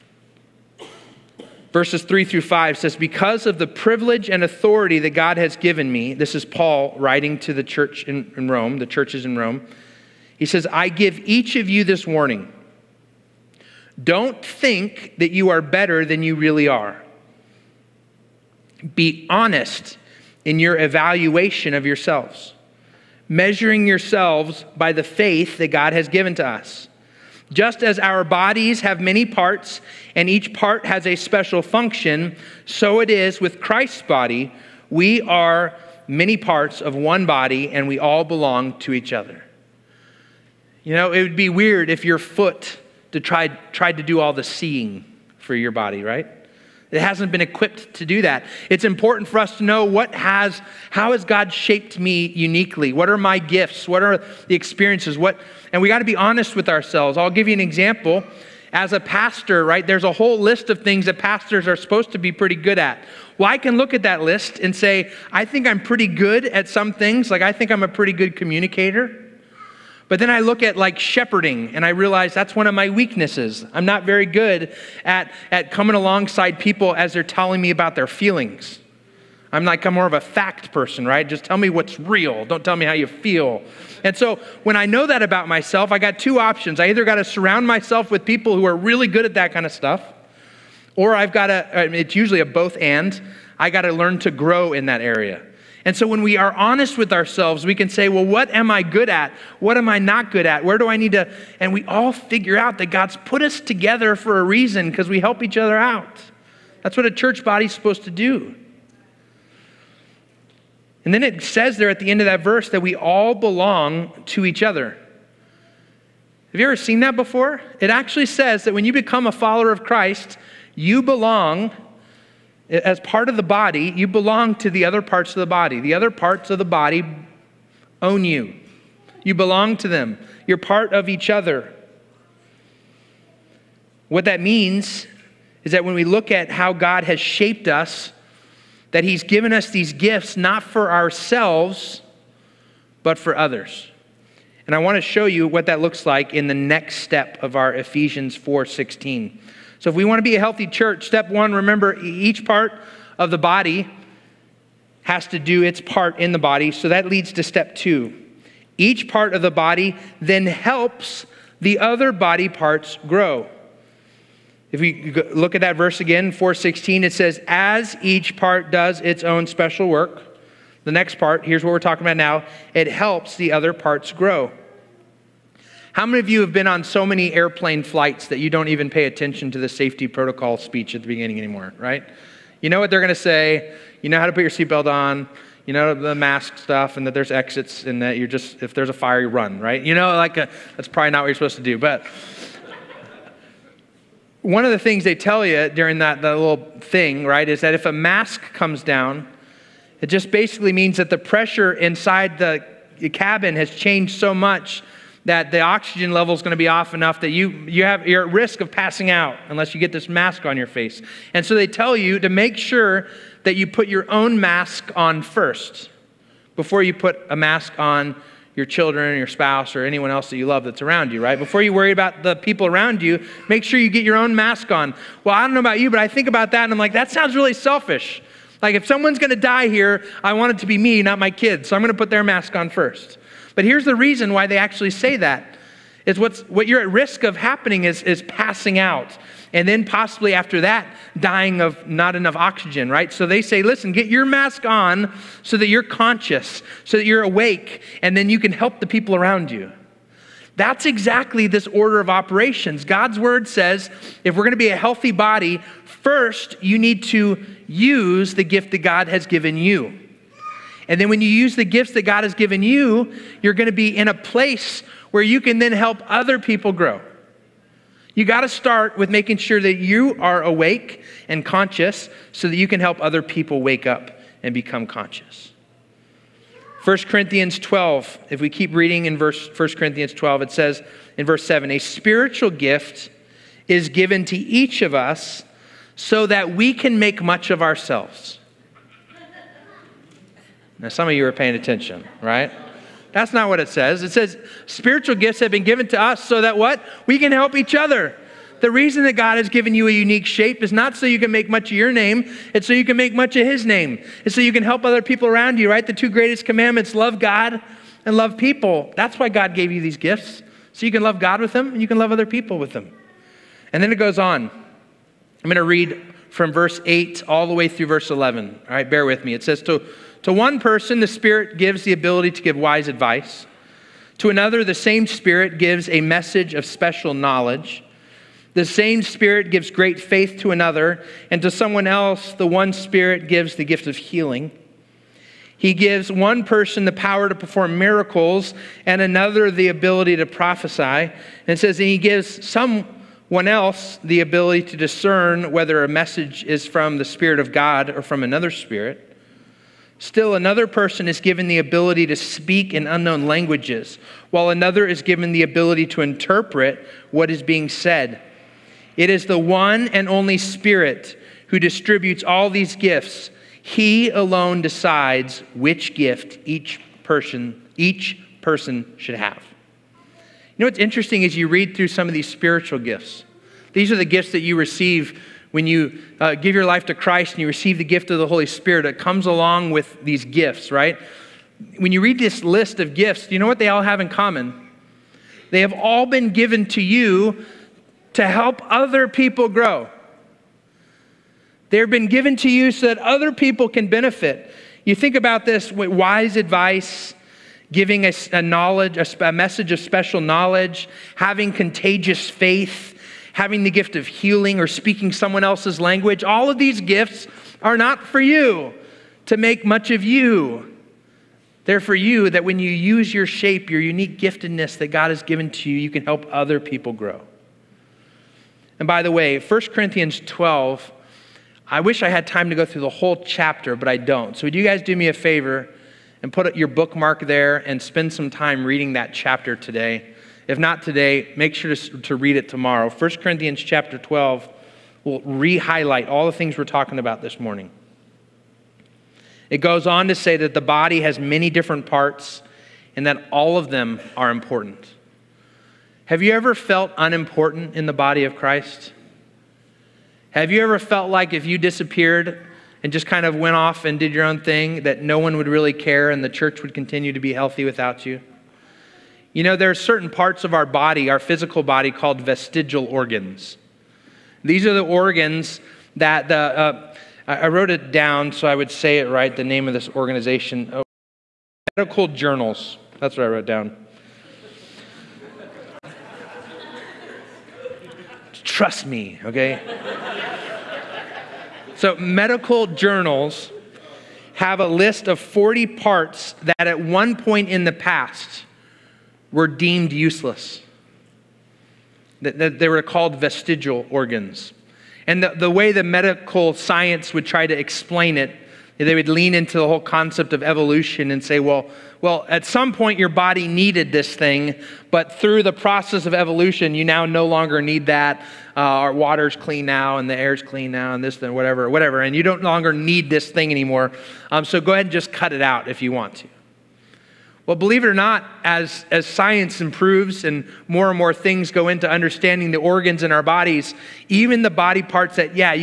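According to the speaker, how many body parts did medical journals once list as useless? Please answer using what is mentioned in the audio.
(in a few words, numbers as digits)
40.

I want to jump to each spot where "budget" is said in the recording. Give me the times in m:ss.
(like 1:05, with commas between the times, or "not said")
not said.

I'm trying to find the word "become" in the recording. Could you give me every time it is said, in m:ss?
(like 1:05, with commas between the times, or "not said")
1:58, 4:34.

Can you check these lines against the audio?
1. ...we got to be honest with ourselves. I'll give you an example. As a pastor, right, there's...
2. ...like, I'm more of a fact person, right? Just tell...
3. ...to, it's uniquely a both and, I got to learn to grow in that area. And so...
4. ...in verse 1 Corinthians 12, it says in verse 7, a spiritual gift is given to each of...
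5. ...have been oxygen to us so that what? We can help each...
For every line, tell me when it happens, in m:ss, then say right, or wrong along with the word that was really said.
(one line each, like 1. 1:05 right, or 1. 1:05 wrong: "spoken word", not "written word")
1. 0:55 right
2. 1:19 right
3. 1:31 wrong: "usually", not "uniquely"
4. 4:39 right
5. 4:55 wrong: "given", not "oxygen".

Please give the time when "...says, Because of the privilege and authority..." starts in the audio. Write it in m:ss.
0:02.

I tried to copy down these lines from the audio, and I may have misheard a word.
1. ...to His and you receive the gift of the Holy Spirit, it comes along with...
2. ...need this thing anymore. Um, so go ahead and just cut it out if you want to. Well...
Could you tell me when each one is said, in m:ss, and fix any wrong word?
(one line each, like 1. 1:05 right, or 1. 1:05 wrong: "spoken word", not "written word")
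1. 6:16 wrong: "Christ", not "His"
2. 8:32 right.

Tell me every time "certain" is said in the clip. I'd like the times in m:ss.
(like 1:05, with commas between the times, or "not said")
7:39.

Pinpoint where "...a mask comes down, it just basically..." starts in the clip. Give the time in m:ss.
3:17.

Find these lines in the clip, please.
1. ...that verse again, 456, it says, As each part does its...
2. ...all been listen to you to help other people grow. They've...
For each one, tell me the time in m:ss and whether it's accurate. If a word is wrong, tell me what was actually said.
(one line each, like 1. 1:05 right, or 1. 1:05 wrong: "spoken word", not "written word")
1. 2:45 wrong: "416", not "456"
2. 6:25 wrong: "given", not "listen".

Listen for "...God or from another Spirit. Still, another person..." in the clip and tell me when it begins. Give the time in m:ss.
5:47.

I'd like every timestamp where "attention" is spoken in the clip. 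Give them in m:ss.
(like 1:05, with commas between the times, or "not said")
2:59, 4:51.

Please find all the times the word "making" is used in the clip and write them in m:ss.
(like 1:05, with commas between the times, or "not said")
4:29.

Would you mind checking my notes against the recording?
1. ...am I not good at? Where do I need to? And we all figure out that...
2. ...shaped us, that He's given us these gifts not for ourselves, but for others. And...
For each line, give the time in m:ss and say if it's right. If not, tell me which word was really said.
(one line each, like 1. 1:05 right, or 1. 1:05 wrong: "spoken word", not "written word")
1. 1:39 right
2. 2:17 right.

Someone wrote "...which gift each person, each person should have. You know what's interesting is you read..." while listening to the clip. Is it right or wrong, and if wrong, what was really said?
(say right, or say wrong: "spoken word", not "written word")
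right.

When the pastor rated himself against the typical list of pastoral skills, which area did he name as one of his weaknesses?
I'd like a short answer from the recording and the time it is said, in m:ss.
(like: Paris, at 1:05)
Shepherding, at 1:10.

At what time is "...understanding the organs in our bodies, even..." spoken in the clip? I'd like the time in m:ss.
8:41.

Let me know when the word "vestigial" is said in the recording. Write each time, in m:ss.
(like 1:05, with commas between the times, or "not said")
7:42, 8:13.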